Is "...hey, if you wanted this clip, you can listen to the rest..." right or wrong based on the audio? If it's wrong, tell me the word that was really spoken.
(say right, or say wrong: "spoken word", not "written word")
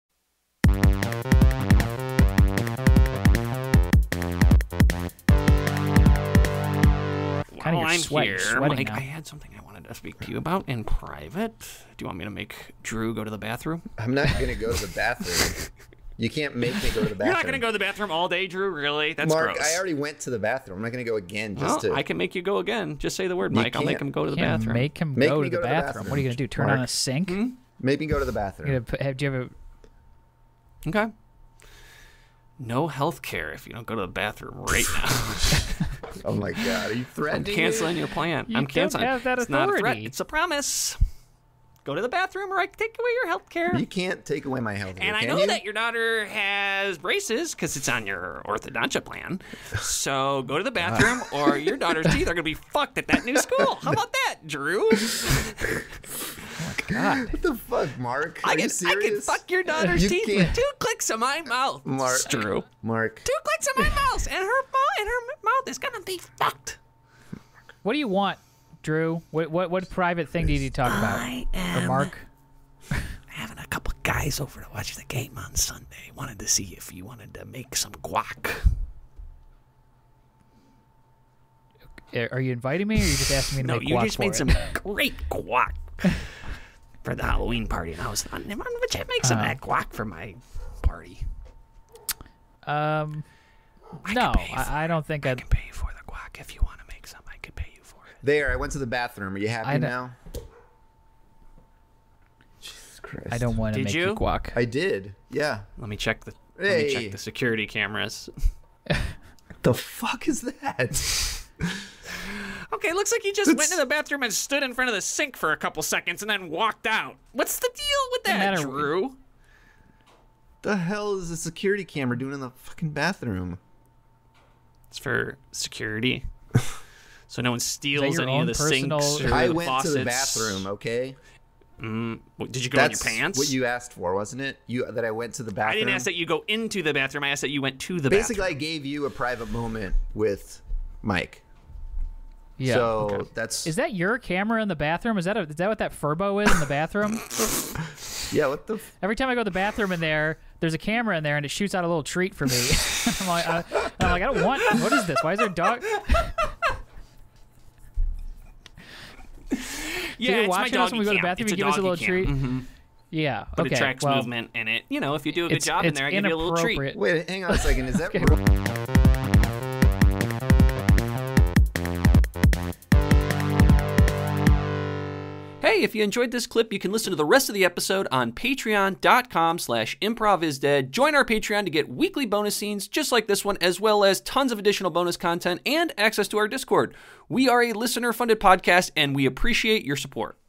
wrong: "enjoyed", not "wanted".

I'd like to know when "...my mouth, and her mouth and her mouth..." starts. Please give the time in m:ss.
1:03.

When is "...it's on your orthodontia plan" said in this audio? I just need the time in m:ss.
0:47.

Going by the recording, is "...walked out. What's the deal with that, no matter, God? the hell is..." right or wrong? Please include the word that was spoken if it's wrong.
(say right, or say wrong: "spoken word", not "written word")
wrong: "Drew", not "God".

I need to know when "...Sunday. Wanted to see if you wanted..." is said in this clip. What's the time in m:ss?
1:15.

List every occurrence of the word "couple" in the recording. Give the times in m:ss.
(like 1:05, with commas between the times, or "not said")
1:13, 1:55.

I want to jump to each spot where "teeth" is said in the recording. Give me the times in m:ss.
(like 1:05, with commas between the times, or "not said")
0:52, 1:00.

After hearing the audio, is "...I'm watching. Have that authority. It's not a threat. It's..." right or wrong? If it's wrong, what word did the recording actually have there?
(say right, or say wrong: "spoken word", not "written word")
wrong: "canceling", not "watching".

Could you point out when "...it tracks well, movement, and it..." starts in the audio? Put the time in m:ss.
2:43.